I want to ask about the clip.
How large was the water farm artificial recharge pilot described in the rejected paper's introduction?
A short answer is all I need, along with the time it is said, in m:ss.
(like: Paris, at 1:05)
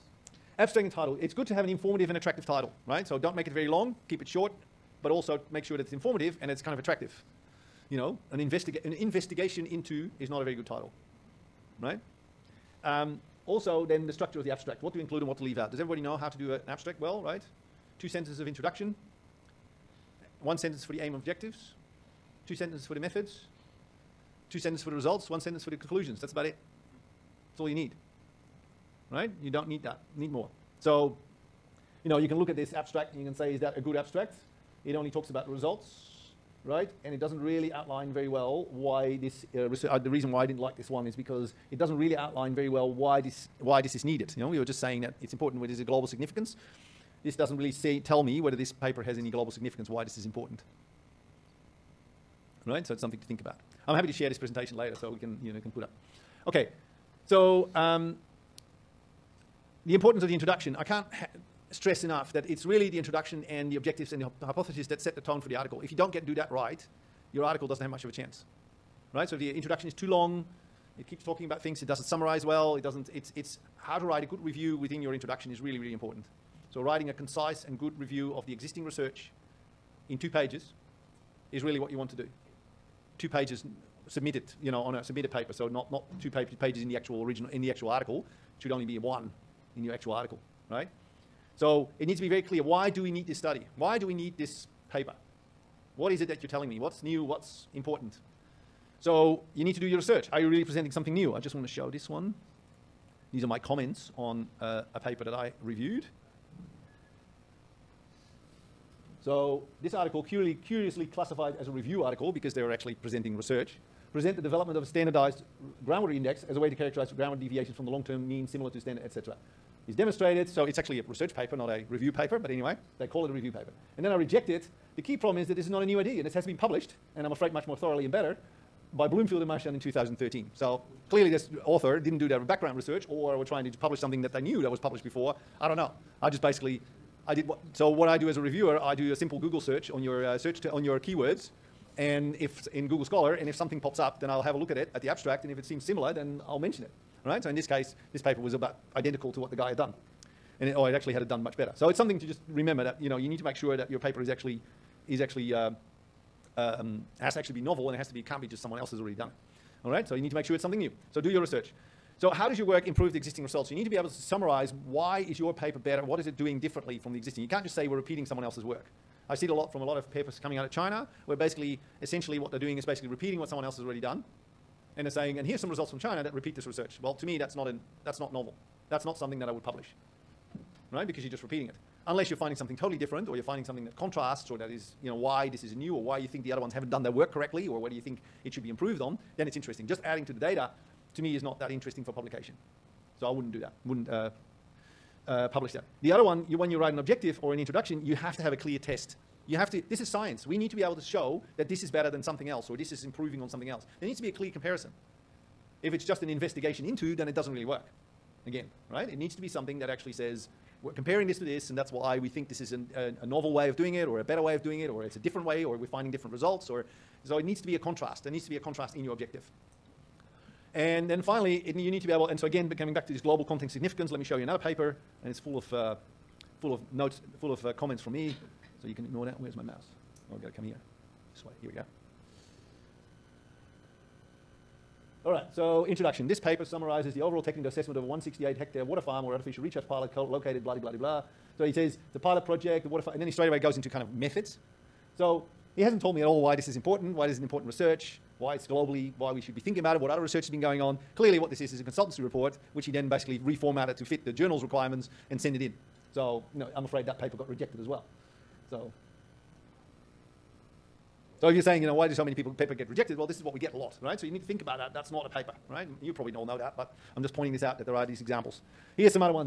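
168 hectares, at 3:58.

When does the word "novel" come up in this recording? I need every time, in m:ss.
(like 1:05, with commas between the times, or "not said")
2:37, 2:58, 3:33.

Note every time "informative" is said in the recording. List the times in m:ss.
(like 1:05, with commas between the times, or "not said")
0:01, 0:05.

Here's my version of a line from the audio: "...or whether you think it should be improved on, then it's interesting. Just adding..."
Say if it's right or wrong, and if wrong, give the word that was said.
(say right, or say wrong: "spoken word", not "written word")
right.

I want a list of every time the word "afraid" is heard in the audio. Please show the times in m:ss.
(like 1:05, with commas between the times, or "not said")
2:07, 4:16.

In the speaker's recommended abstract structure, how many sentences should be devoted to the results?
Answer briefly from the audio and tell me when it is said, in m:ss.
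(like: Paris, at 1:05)
2, at 0:24.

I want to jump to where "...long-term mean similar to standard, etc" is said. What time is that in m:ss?
1:57.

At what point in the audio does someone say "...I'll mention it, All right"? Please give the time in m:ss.
2:26.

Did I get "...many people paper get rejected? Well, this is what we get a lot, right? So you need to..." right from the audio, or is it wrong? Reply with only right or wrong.
right.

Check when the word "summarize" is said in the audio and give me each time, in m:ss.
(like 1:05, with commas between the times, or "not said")
1:12, 2:44, 3:56.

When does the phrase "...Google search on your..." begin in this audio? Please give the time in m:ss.
2:19.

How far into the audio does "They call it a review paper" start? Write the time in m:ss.
2:02.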